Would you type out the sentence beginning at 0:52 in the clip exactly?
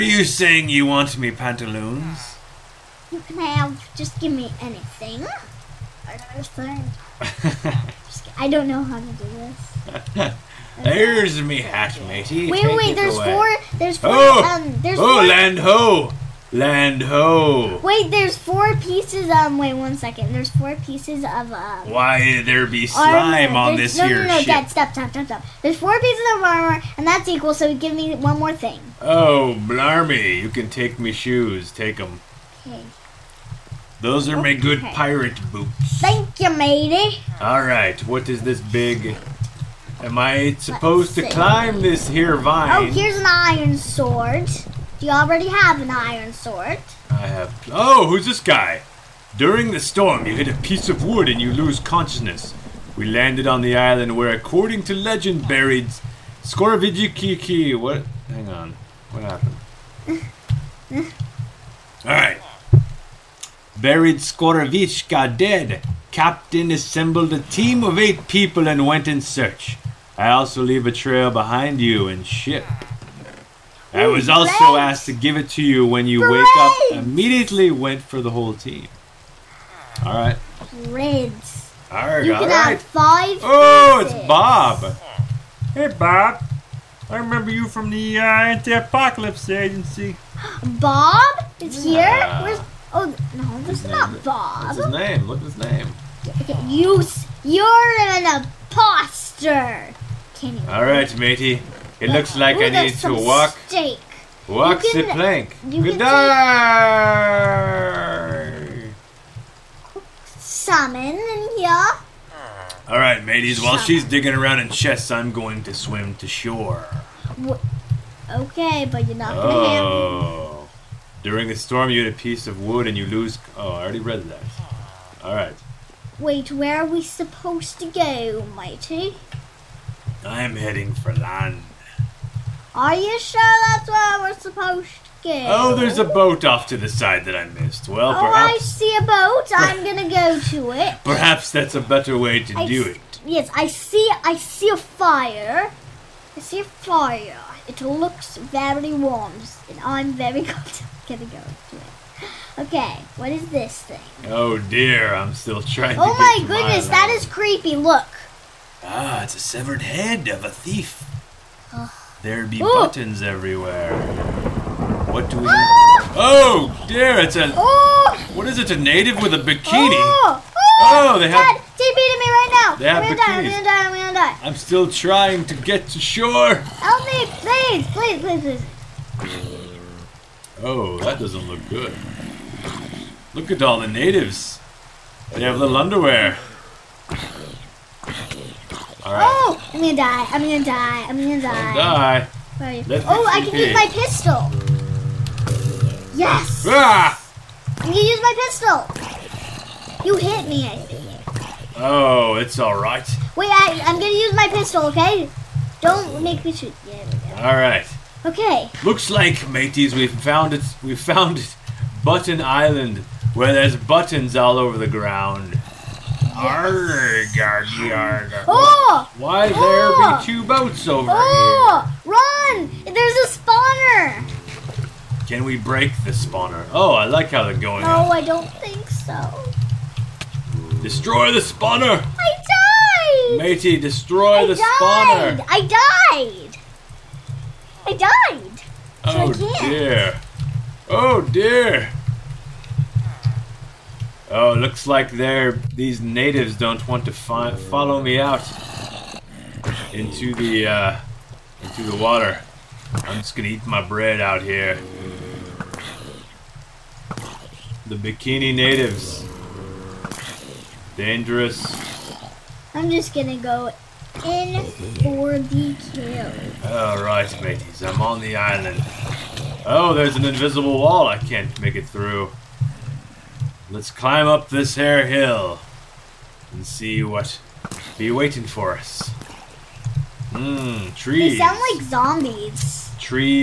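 We landed on the island where, according to legend, buried Skorovijikiki.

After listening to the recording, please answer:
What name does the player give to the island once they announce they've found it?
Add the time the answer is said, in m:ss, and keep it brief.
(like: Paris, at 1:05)
Button Island, at 3:32.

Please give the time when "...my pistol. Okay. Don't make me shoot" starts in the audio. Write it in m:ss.
3:24.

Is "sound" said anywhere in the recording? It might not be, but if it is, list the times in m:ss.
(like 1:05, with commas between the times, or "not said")
4:41.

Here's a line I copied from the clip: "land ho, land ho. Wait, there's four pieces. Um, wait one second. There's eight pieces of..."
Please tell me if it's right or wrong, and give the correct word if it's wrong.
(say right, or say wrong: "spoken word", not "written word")
wrong: "four", not "eight".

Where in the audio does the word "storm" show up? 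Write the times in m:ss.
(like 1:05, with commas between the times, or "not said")
0:49, 2:01.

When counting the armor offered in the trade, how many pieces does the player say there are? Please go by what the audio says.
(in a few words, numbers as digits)
4.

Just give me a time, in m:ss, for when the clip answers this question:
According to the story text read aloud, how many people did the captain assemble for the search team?
1:07.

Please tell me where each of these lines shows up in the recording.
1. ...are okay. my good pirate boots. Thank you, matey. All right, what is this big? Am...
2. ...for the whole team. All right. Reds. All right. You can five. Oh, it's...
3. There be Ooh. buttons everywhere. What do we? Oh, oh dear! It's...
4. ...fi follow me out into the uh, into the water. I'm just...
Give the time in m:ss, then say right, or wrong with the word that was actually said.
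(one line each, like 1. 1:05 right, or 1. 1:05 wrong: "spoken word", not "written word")
1. 0:34 right
2. 1:18 right
3. 2:42 right
4. 4:07 right.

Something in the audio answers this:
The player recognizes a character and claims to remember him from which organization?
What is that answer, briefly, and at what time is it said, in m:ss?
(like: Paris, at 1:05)
Anti-Apocalypse Agency, at 1:28.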